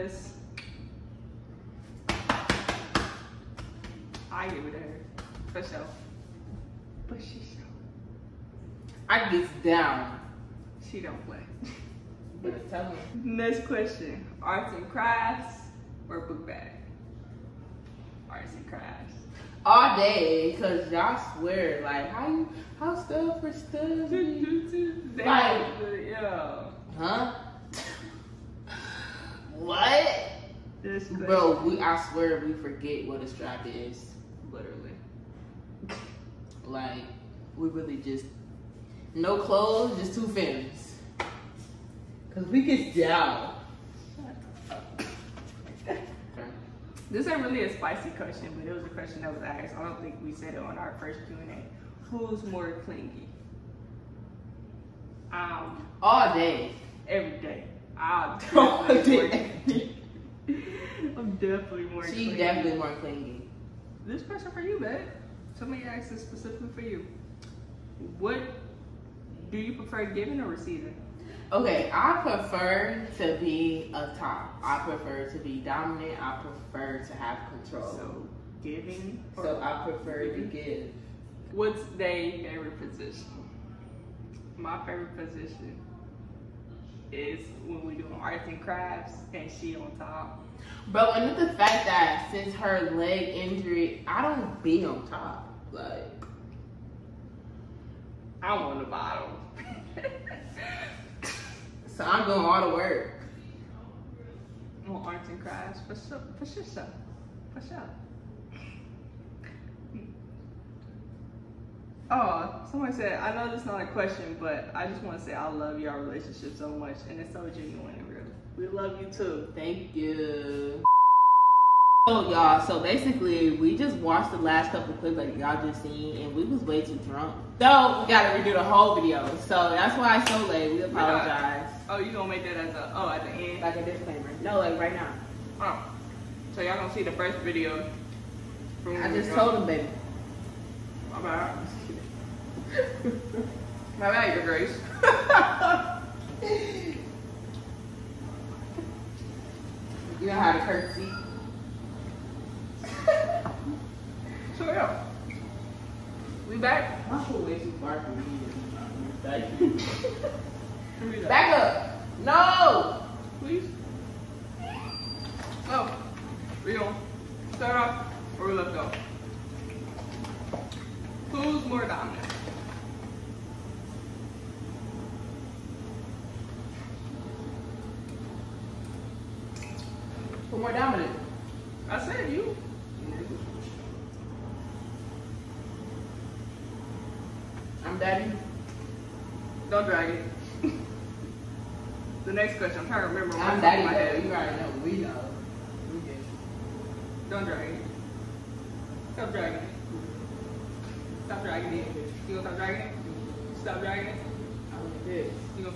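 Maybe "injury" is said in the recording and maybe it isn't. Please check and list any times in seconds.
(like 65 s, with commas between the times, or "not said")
93 s.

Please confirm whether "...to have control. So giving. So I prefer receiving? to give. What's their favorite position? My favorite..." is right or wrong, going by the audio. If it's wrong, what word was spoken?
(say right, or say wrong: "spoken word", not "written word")
wrong: "giving", not "receiving".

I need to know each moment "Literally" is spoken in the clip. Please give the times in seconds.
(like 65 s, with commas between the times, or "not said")
34 s.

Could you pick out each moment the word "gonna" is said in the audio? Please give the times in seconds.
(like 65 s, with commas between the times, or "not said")
132 s, 136 s, 202 s.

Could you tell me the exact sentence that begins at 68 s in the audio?
What do you prefer giving or receiving?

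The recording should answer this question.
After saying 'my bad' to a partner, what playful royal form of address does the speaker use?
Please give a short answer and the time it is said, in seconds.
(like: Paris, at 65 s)
Your Grace, at 144 s.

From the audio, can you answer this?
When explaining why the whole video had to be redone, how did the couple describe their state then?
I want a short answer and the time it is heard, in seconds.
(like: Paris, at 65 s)
way too drunk, at 126 s.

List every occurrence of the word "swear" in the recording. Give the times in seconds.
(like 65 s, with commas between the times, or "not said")
21 s, 32 s.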